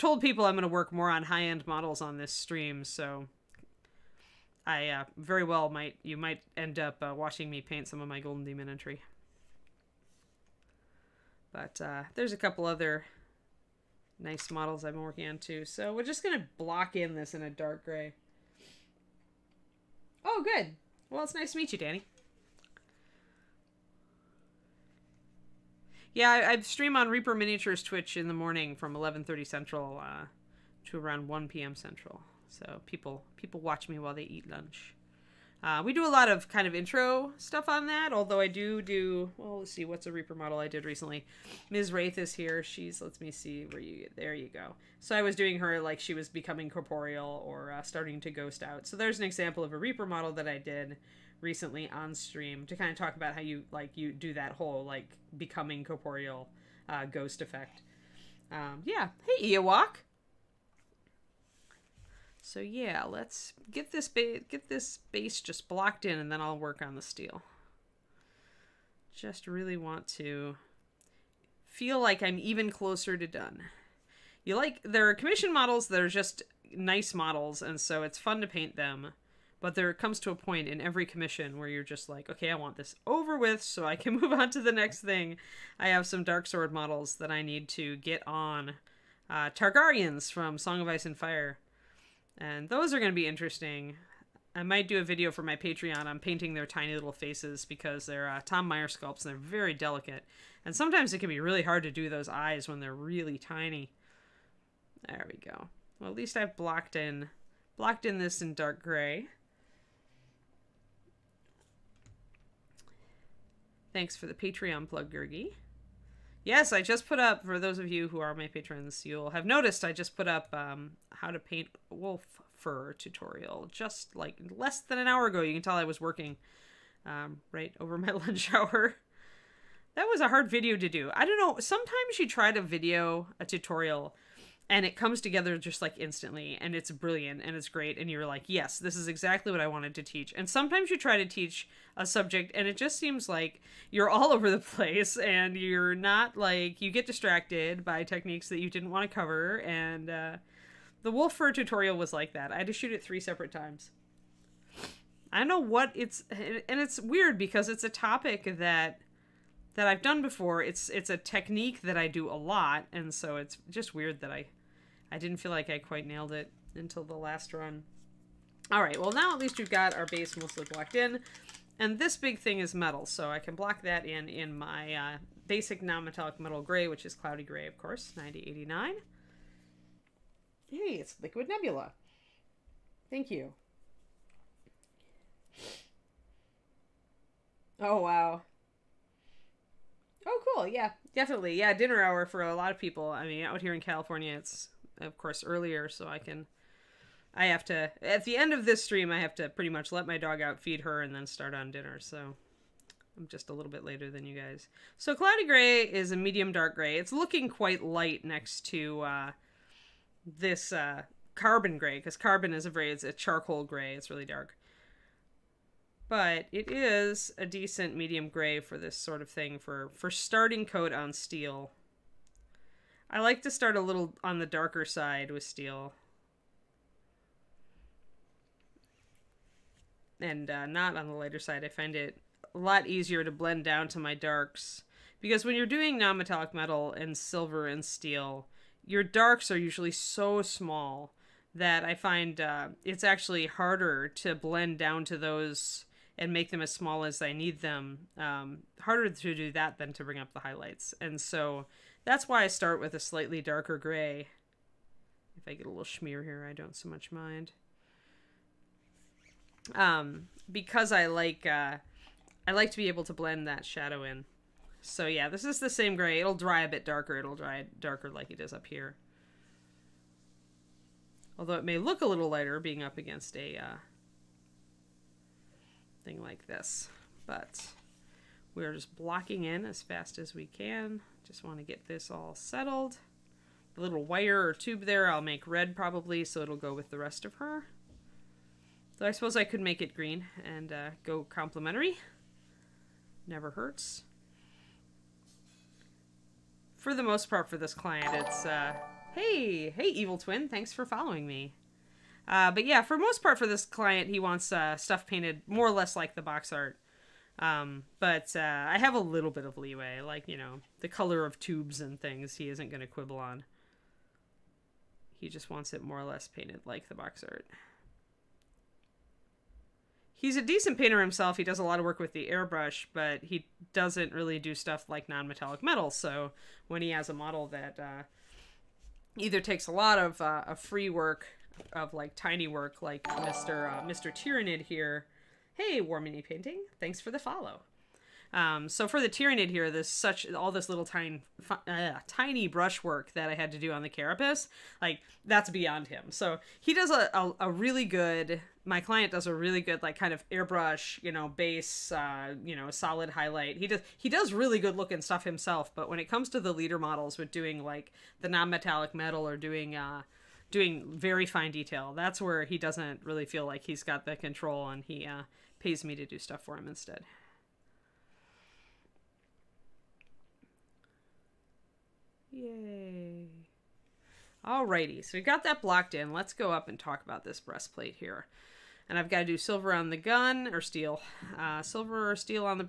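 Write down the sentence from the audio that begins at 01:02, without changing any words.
So yeah, let's get this base get this base just blocked in and then I'll work on the steel.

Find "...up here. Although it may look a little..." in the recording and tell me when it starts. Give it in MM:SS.
04:28.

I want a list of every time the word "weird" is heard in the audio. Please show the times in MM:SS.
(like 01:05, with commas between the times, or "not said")
02:36, 02:43.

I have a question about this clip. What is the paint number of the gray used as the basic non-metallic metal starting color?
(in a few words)
9089.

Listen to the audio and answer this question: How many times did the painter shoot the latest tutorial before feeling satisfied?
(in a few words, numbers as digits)
3.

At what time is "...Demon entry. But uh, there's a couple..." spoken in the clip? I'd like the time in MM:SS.
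00:08.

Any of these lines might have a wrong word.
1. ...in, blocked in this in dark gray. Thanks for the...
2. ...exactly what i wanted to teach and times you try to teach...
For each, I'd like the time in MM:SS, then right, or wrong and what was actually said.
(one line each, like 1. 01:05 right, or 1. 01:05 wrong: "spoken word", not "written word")
1. 01:46 right
2. 02:19 wrong: "sometimes", not "times".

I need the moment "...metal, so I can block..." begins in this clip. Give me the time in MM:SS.
02:52.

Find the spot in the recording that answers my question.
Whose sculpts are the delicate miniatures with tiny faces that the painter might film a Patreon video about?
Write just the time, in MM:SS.
01:38.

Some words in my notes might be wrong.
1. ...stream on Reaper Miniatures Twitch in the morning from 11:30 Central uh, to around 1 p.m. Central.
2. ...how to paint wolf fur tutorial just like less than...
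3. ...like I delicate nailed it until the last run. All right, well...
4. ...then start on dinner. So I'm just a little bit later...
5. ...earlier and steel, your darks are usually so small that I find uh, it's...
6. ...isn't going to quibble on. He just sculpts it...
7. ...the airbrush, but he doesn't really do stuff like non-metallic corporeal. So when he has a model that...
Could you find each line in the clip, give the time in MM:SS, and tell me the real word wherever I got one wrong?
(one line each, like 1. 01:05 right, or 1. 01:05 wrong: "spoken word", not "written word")
1. 00:26 right
2. 02:01 right
3. 02:45 wrong: "quite", not "delicate"
4. 03:21 right
5. 03:57 wrong: "silver", not "earlier"
6. 05:12 wrong: "wants", not "sculpts"
7. 05:22 wrong: "metal", not "corporeal".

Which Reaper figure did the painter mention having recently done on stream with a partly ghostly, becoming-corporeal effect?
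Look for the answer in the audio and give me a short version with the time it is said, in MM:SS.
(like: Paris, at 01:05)
Ms. Wraith, at 00:41.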